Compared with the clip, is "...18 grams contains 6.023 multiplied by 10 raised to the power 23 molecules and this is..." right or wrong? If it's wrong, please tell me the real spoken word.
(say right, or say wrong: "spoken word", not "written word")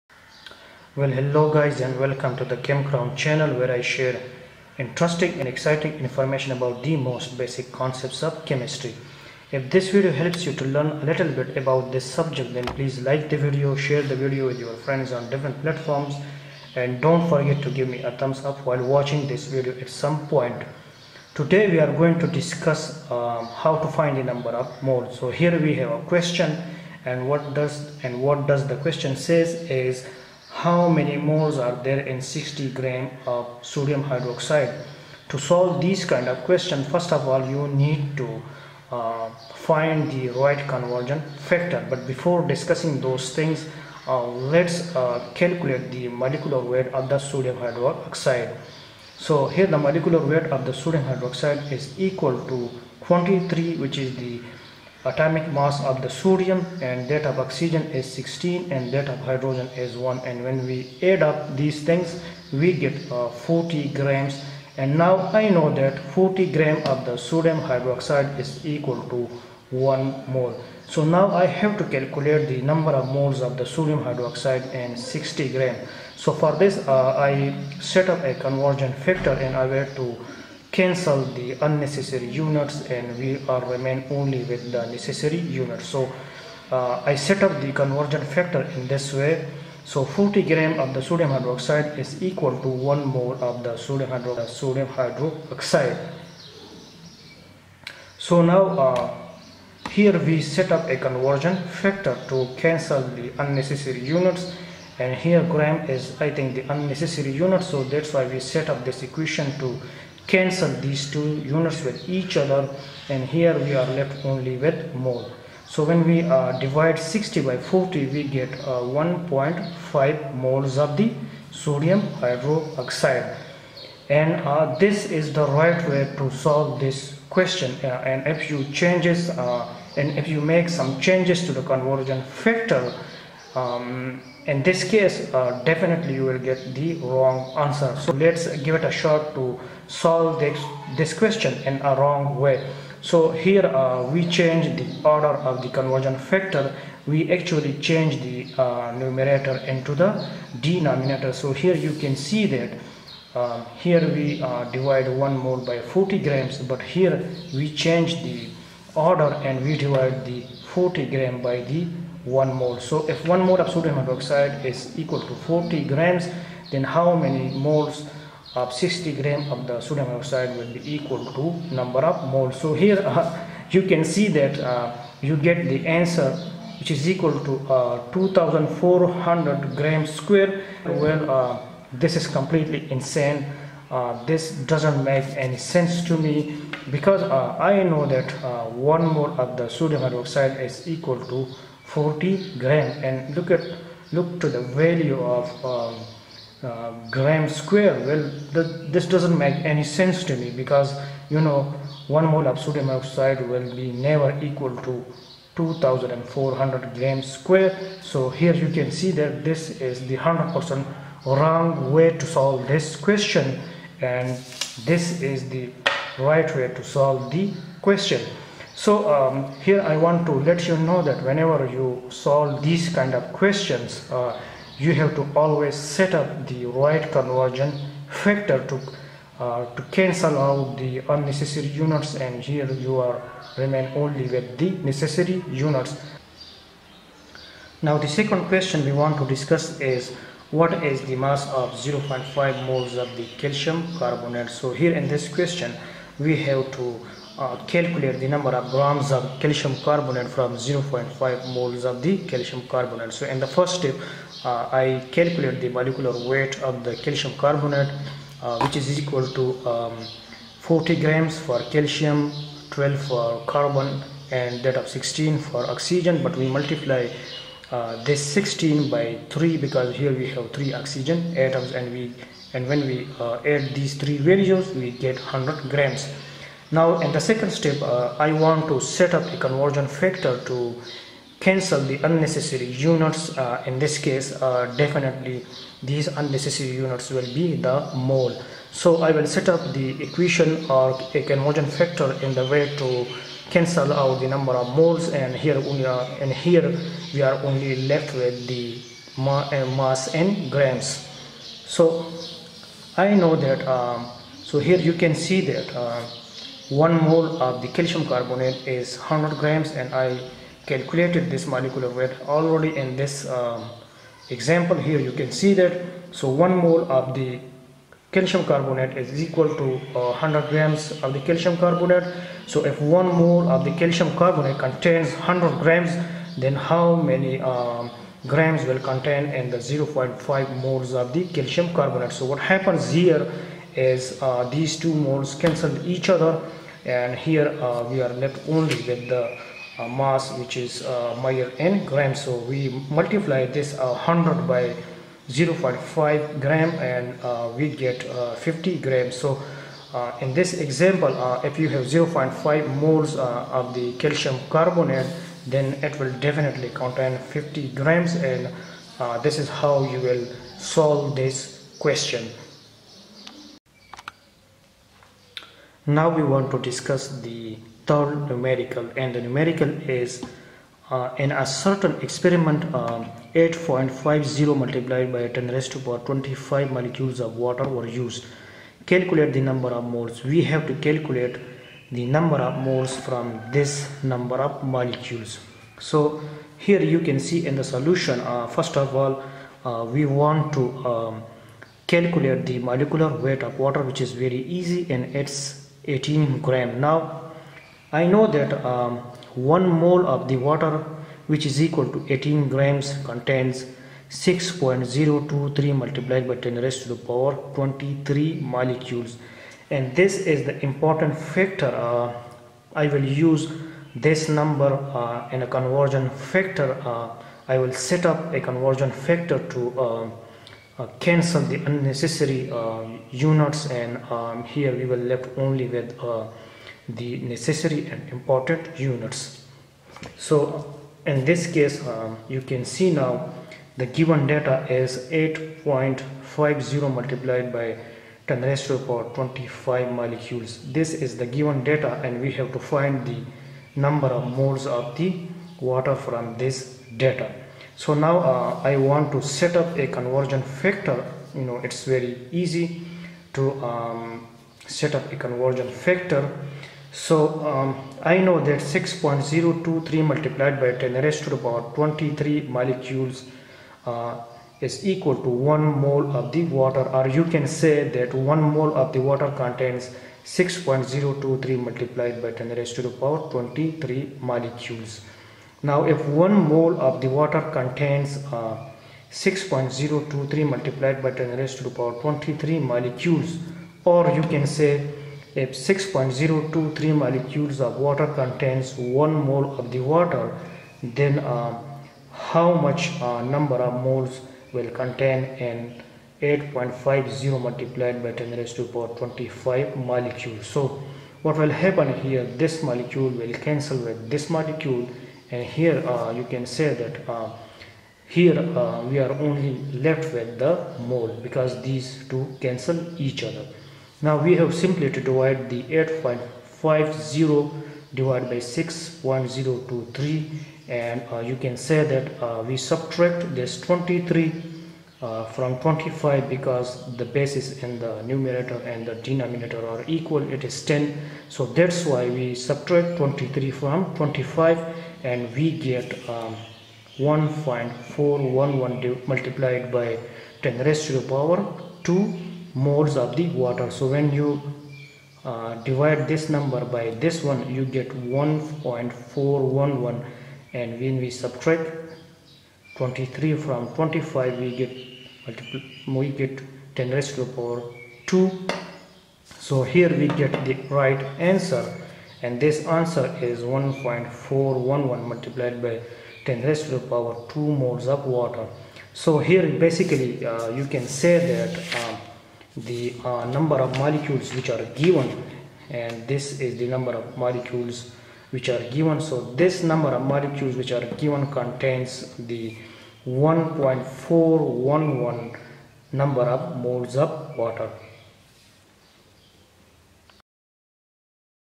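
right.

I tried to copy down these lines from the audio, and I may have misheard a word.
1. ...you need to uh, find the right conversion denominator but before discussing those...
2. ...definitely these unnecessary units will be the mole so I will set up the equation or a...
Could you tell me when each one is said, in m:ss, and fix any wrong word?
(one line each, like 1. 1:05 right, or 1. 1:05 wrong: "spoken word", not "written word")
1. 0:37 wrong: "factor", not "denominator"
2. 4:44 right.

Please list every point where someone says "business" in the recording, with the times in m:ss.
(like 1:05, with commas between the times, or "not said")
not said.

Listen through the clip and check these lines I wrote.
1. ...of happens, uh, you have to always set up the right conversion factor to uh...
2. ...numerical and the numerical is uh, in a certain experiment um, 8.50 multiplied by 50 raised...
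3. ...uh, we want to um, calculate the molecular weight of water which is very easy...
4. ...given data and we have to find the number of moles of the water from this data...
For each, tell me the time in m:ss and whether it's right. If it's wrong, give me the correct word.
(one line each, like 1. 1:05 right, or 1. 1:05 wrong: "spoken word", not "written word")
1. 3:43 wrong: "questions", not "happens"
2. 6:08 wrong: "10", not "50"
3. 6:29 right
4. 7:21 right.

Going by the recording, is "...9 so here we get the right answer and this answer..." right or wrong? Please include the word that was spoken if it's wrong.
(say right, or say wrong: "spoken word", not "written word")
wrong: "2", not "9".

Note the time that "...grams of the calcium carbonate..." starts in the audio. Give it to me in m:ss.
5:20.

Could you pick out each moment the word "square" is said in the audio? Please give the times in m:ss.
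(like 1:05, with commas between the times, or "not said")
3:00, 3:17, 3:27.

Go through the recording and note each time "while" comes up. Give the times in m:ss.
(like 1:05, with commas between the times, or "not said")
0:18.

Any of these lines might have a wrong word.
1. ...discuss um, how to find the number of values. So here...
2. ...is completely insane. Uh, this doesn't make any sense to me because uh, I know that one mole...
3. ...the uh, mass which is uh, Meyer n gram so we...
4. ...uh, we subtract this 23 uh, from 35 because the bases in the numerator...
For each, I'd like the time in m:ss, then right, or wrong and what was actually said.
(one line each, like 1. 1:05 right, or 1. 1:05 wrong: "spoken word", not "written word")
1. 0:22 wrong: "moles", not "values"
2. 3:02 right
3. 5:39 right
4. 8:42 wrong: "25", not "35".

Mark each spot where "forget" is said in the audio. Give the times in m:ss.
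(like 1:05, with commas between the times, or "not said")
0:17.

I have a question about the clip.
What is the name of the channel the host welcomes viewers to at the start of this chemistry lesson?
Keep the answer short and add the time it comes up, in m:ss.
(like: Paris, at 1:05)
ChemCrown, at 0:02.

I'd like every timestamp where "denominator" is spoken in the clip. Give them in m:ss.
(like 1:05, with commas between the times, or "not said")
2:30, 8:48.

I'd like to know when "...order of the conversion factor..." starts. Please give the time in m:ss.
2:25.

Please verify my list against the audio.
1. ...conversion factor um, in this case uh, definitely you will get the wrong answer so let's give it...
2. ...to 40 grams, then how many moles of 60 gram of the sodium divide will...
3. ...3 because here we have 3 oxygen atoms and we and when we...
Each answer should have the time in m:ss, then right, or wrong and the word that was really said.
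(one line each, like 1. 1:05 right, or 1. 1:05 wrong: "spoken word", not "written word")
1. 2:11 right
2. 2:45 wrong: "hydroxide", not "divide"
3. 4:29 right.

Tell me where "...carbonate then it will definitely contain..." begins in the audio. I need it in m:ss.
5:54.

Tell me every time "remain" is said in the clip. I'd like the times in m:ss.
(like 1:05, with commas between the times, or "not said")
1:23, 3:53.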